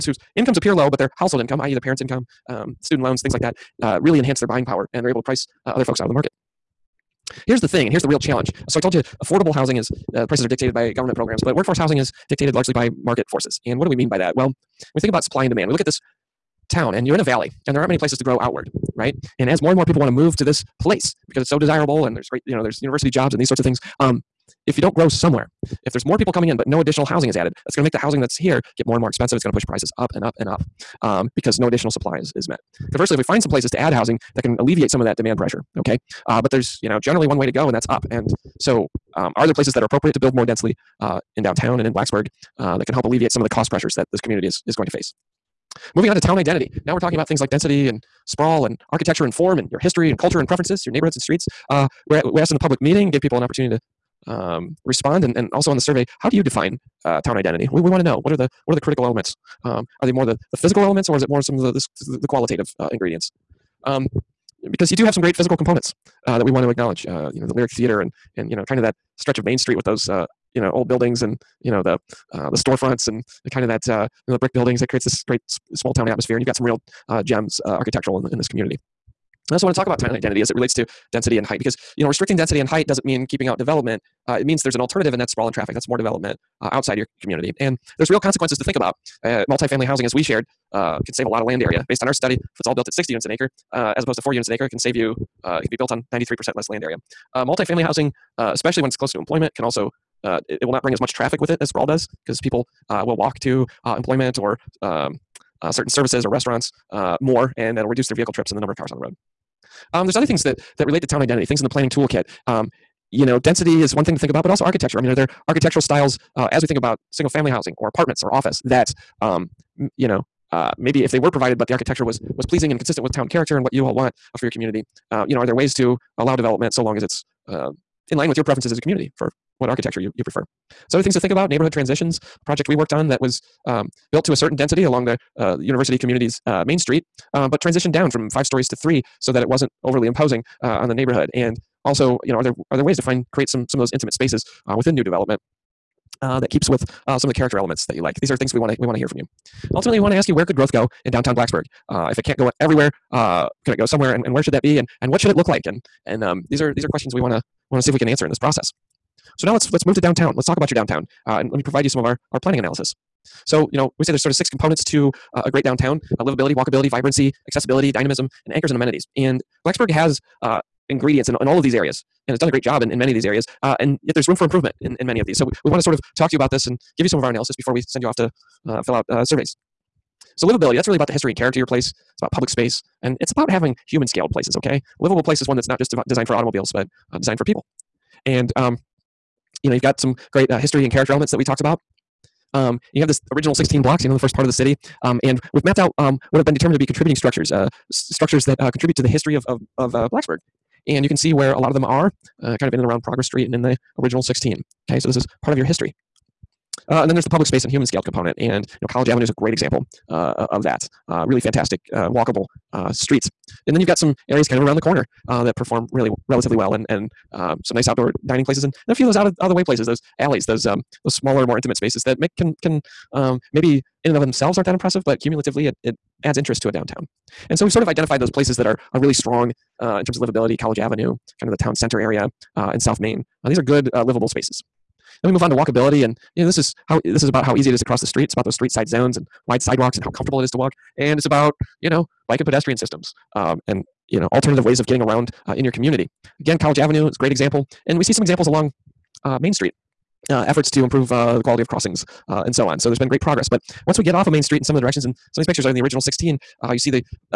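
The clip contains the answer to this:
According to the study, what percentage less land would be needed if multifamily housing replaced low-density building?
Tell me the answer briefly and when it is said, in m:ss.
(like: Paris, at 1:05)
93%, at 1:36.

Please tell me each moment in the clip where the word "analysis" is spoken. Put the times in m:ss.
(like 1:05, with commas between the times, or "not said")
2:42, 2:57.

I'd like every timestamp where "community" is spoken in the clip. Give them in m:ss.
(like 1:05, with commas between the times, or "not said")
0:44, 1:18, 1:27, 2:04, 2:08, 2:15, 4:05.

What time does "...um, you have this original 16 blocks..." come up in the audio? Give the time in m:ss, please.
3:12.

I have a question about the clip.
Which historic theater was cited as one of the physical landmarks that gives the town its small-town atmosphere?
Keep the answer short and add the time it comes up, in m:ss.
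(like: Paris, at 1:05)
Lyric Theater, at 1:07.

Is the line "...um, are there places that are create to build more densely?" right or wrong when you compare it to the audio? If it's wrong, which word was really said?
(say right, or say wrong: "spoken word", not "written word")
wrong: "appropriate", not "create".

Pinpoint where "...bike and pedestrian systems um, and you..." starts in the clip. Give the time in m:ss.
4:02.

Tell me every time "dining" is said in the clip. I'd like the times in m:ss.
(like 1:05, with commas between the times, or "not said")
3:38.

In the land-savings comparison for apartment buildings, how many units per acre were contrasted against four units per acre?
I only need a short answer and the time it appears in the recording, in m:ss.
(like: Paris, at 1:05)
60, at 1:32.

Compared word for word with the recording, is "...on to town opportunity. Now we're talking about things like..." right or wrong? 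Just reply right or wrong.
wrong.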